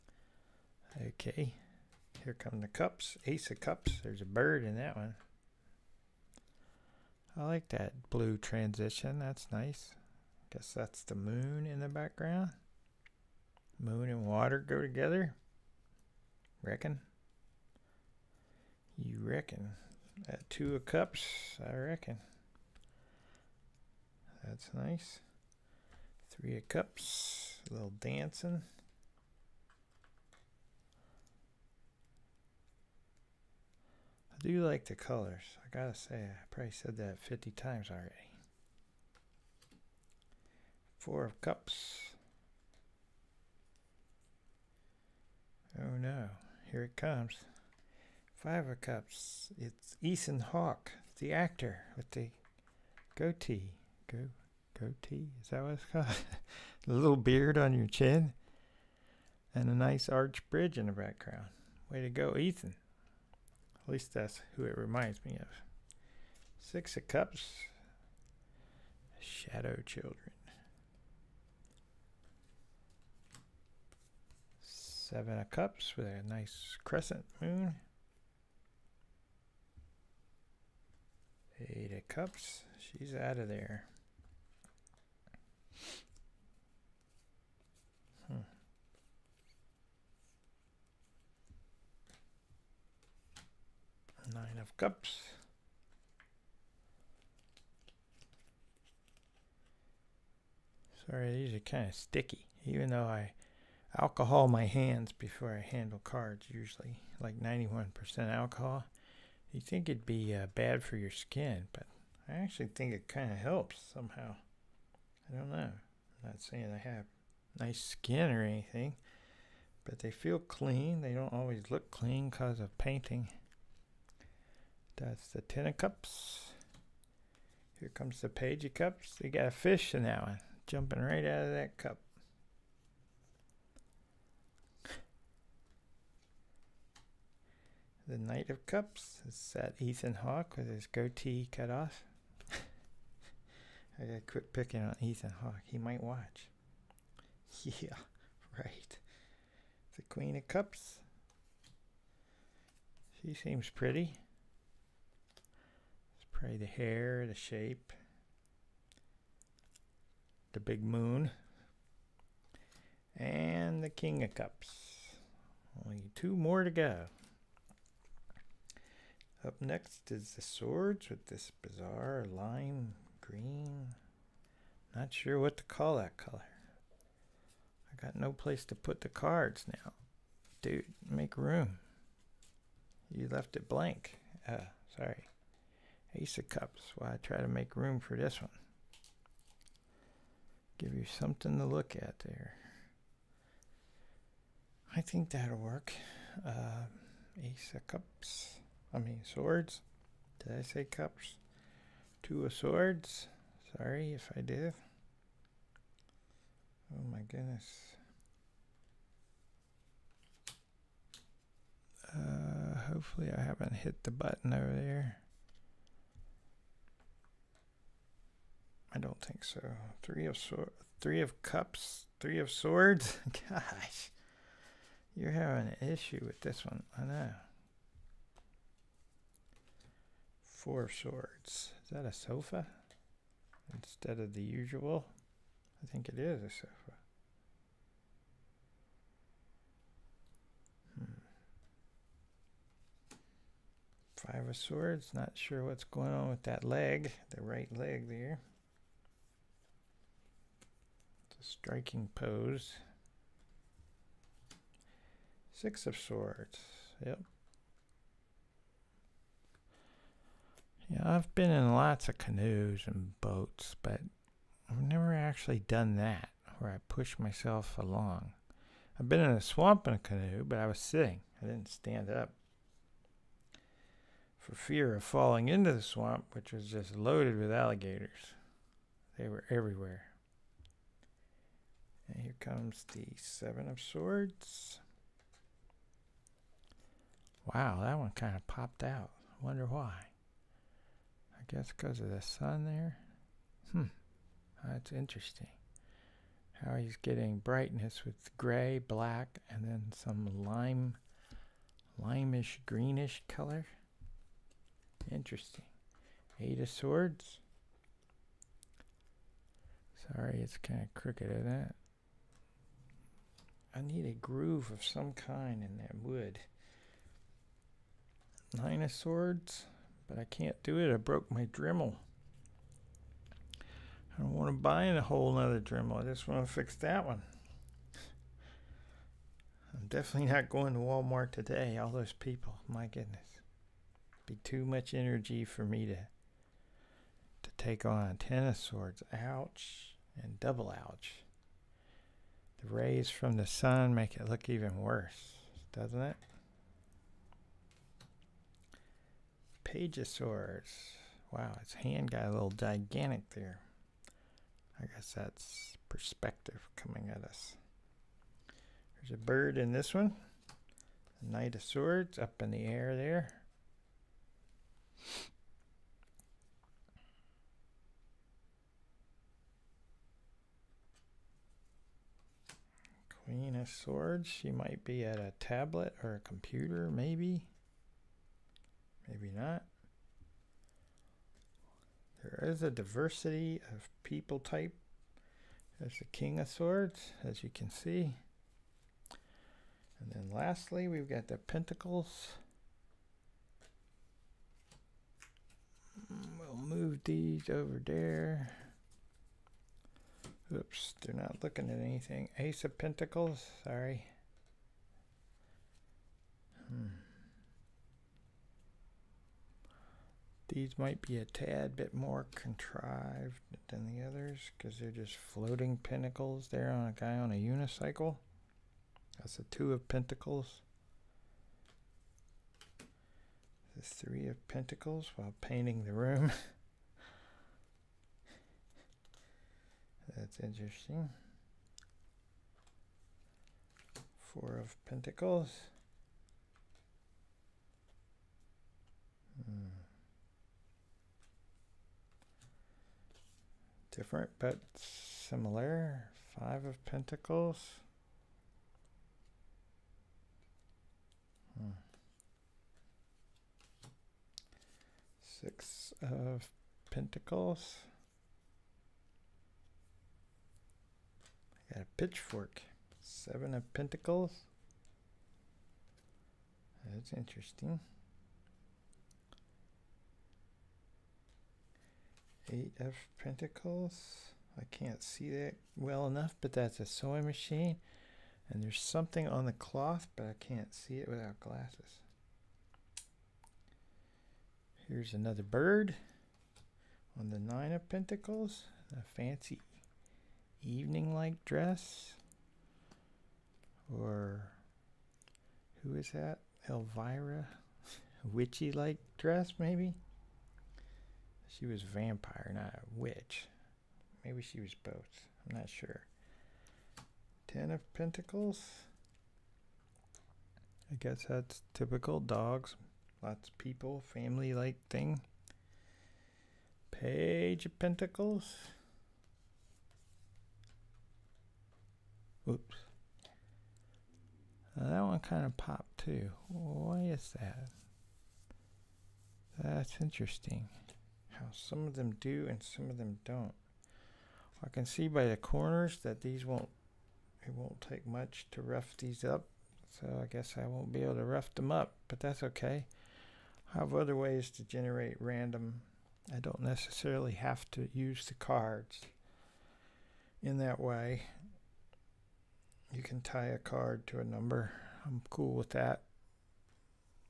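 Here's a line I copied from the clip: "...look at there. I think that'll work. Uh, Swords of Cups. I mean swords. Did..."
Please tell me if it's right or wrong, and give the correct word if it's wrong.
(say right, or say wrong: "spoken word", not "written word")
wrong: "Ace", not "Swords".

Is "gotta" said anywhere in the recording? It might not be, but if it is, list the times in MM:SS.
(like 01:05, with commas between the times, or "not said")
00:35, 02:24.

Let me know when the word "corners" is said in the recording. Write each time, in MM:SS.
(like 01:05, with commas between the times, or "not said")
08:55.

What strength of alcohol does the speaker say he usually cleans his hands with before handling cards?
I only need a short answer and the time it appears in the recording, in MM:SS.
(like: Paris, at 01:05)
91%, at 01:47.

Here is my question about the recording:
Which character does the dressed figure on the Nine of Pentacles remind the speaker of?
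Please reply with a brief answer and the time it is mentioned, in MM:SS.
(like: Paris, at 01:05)
Elvira, at 08:16.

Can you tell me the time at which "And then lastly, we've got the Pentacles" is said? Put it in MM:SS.
06:29.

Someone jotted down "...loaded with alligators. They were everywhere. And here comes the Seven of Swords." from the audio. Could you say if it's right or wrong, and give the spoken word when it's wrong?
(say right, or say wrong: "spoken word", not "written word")
right.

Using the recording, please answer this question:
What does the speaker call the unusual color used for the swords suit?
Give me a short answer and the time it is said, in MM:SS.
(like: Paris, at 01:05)
lime green, at 02:52.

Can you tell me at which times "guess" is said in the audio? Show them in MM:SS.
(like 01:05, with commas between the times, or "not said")
00:10, 04:51, 05:54, 08:30, 09:00.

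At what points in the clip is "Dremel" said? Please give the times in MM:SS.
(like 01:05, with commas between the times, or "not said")
05:21, 05:25.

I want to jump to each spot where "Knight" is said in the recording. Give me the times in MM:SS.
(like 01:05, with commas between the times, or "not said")
02:18, 06:01.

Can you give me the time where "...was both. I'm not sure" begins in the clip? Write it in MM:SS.
08:24.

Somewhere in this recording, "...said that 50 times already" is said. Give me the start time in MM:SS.
00:36.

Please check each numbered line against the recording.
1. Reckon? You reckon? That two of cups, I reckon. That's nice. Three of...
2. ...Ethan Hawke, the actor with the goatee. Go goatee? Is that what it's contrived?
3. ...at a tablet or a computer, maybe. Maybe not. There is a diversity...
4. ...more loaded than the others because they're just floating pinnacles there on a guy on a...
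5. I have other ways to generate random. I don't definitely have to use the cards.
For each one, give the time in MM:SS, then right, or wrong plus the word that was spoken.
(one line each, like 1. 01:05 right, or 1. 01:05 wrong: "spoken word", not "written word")
1. 00:16 right
2. 00:49 wrong: "called", not "contrived"
3. 06:15 right
4. 06:51 wrong: "contrived", not "loaded"
5. 09:03 wrong: "necessarily", not "definitely".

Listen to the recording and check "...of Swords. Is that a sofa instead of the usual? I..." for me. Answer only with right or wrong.
right.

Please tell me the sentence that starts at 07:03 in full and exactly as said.
The three of pentacles while painting the room.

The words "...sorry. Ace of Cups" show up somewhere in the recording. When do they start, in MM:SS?
03:04.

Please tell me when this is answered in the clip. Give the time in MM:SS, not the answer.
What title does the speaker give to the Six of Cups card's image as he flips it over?
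01:09.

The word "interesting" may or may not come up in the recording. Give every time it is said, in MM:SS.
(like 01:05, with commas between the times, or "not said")
04:54, 05:05, 07:10, 07:47, 08:50.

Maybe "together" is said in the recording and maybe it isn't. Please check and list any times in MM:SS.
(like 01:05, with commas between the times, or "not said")
00:14.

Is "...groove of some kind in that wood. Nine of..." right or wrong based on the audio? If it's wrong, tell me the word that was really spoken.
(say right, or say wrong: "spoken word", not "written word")
right.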